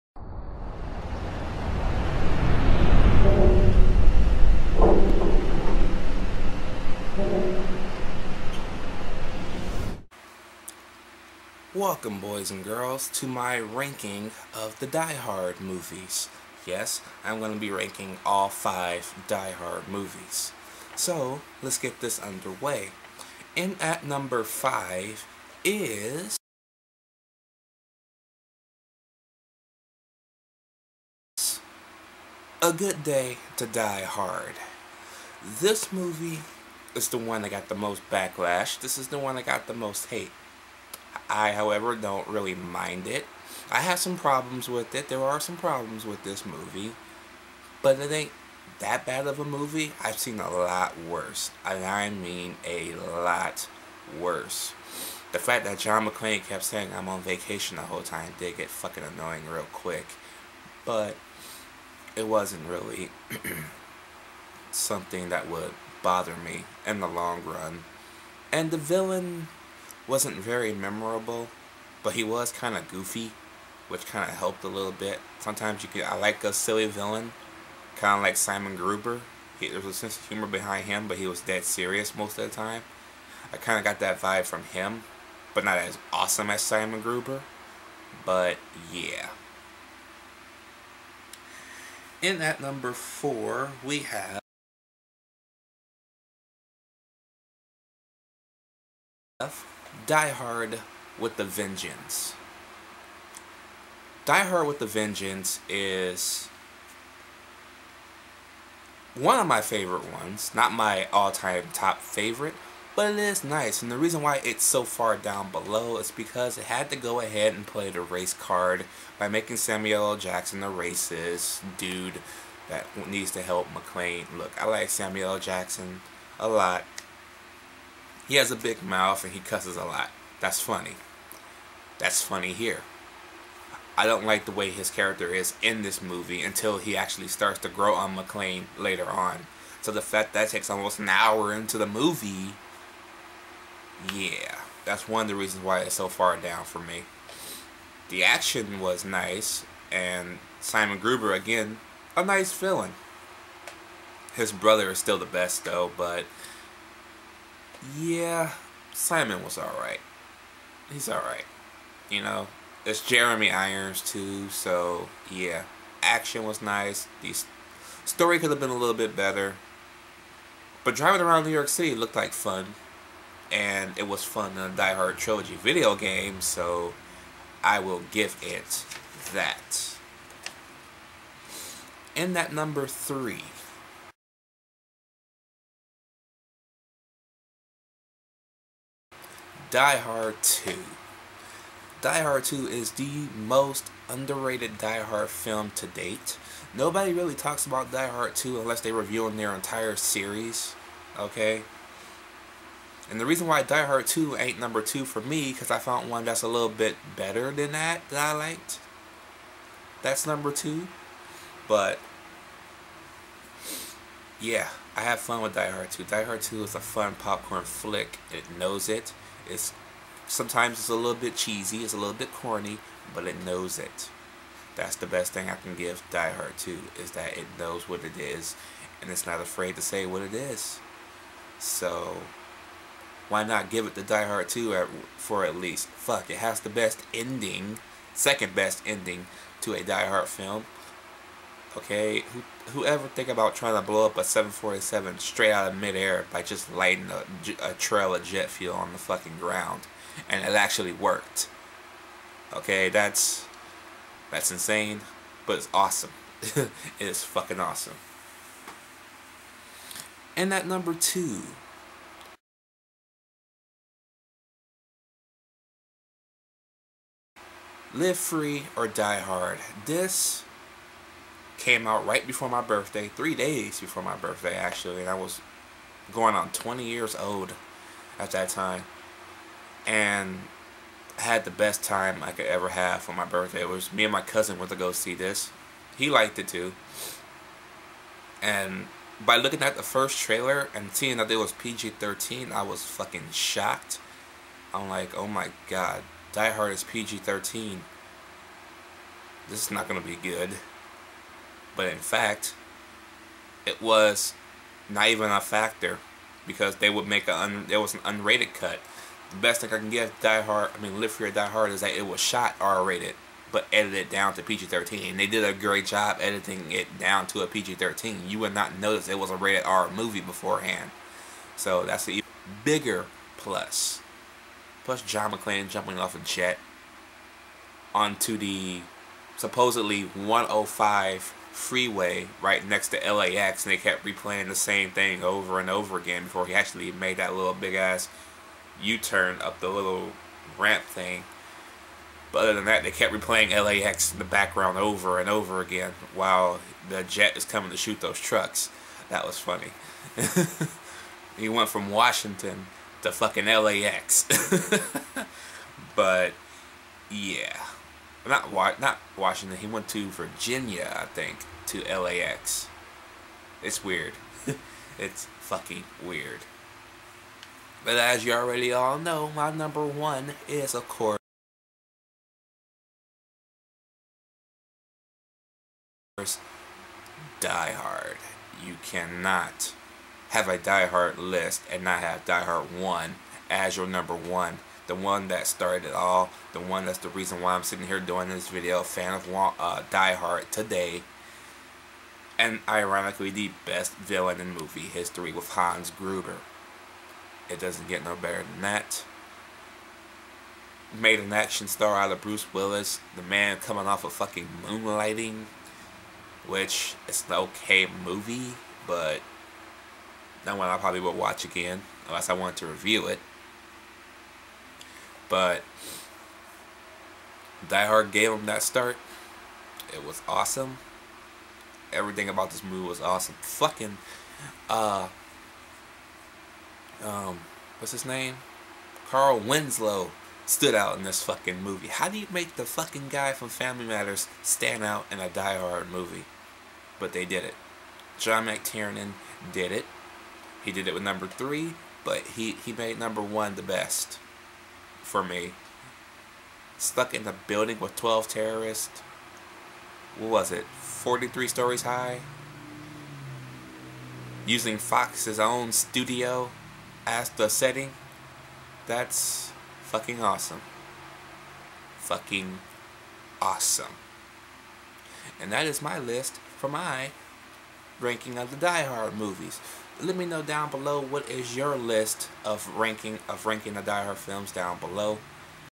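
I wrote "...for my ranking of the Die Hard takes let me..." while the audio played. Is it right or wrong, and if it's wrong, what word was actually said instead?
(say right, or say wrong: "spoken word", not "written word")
wrong: "movies", not "takes".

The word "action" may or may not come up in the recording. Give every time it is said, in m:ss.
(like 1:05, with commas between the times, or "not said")
2:28, 2:46, 6:41.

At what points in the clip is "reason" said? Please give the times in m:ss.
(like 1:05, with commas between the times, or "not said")
1:53, 2:25, 3:23, 6:27.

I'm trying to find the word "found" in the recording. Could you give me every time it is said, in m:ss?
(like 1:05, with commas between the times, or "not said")
3:25.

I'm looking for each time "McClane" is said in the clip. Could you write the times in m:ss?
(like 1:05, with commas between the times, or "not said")
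0:56, 2:03, 2:18, 5:25.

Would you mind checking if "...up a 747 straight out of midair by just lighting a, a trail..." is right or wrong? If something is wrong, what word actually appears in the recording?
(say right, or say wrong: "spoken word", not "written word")
right.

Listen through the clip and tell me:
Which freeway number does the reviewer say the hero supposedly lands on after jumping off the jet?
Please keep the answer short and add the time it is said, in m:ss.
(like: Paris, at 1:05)
105, at 5:30.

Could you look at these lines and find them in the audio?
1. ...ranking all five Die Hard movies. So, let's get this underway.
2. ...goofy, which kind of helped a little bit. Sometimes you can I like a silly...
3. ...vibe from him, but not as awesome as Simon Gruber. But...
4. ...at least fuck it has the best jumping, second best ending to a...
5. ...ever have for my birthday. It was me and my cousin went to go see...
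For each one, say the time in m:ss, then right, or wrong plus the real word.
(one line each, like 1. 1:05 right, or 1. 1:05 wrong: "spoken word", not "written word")
1. 0:17 right
2. 1:12 right
3. 1:24 right
4. 3:55 wrong: "ending", not "jumping"
5. 4:42 right.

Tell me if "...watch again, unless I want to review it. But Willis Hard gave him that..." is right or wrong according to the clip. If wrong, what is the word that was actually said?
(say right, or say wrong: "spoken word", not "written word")
wrong: "Die", not "Willis".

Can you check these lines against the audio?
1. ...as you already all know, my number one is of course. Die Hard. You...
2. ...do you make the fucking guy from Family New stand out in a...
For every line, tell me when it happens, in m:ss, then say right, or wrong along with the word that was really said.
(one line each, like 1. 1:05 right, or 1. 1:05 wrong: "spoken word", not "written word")
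1. 6:07 right
2. 7:12 wrong: "Matters", not "New".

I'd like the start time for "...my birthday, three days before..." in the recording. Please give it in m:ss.
4:32.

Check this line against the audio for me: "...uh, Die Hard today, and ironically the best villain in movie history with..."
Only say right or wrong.
right.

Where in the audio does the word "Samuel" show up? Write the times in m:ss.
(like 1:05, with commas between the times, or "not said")
1:59, 2:04.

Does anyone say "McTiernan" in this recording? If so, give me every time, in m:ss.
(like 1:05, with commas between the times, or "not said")
7:18.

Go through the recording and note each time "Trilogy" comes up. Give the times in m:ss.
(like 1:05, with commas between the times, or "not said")
2:55.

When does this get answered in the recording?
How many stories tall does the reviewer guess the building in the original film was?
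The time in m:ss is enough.
7:30.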